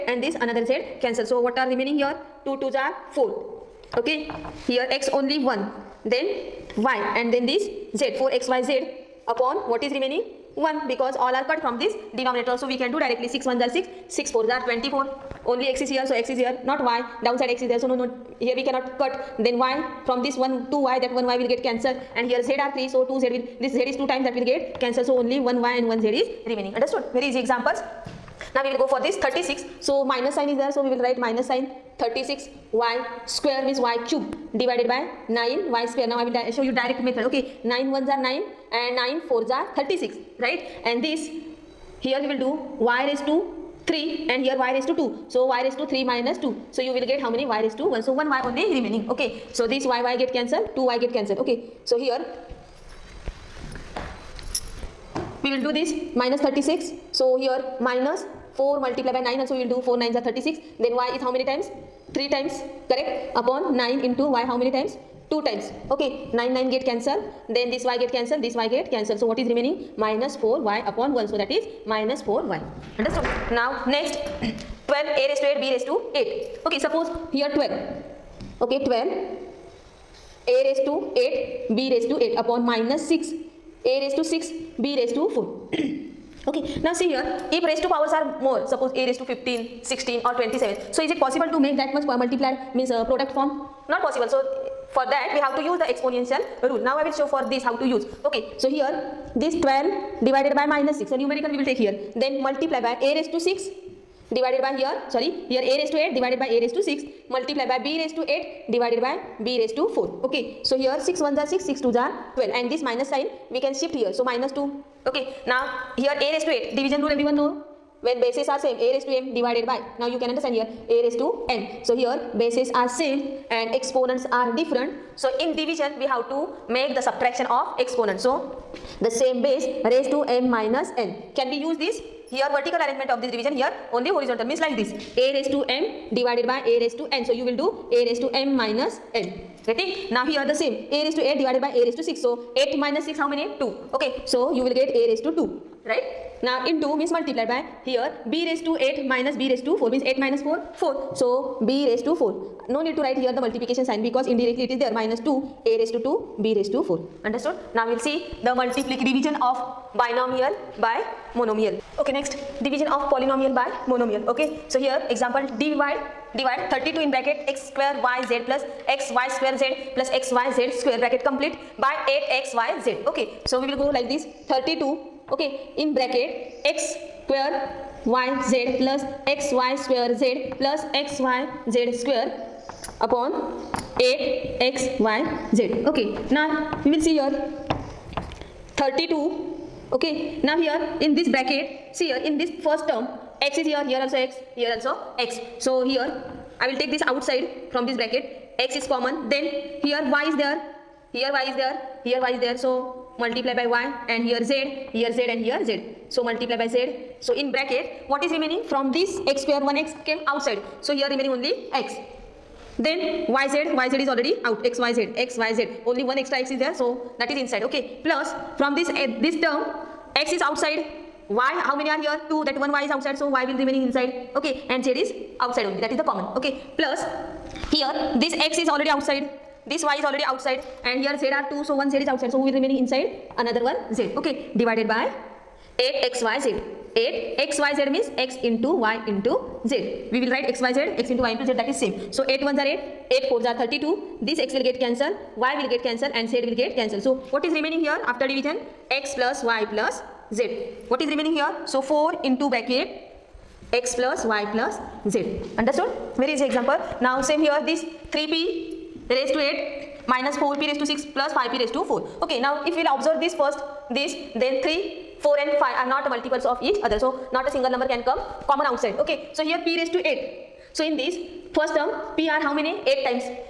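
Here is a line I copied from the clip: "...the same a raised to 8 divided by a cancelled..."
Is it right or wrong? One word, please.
wrong.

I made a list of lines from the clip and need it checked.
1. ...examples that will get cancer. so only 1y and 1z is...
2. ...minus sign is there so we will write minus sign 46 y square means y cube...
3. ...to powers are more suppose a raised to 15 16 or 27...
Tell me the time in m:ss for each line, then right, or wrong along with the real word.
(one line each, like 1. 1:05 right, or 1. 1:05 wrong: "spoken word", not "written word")
1. 0:24 wrong: "times", not "examples"
2. 0:30 wrong: "36", not "46"
3. 1:27 right.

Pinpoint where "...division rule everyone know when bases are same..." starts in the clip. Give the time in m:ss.
1:56.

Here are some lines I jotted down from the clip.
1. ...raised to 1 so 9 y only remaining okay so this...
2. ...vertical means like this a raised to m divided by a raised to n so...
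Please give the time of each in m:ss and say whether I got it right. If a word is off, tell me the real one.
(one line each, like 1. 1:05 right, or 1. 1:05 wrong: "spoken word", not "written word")
1. 0:47 wrong: "1", not "9"
2. 2:14 wrong: "horizontal", not "vertical".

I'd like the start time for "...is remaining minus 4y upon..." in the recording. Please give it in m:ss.
1:09.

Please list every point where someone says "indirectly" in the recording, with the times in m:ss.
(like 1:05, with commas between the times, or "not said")
2:34.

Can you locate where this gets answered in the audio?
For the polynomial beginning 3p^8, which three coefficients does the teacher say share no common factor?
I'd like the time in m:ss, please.
4:24.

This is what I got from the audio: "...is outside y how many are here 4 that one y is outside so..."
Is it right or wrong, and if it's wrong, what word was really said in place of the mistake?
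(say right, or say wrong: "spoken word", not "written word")
wrong: "2", not "4".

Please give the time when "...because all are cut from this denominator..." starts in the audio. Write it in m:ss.
0:10.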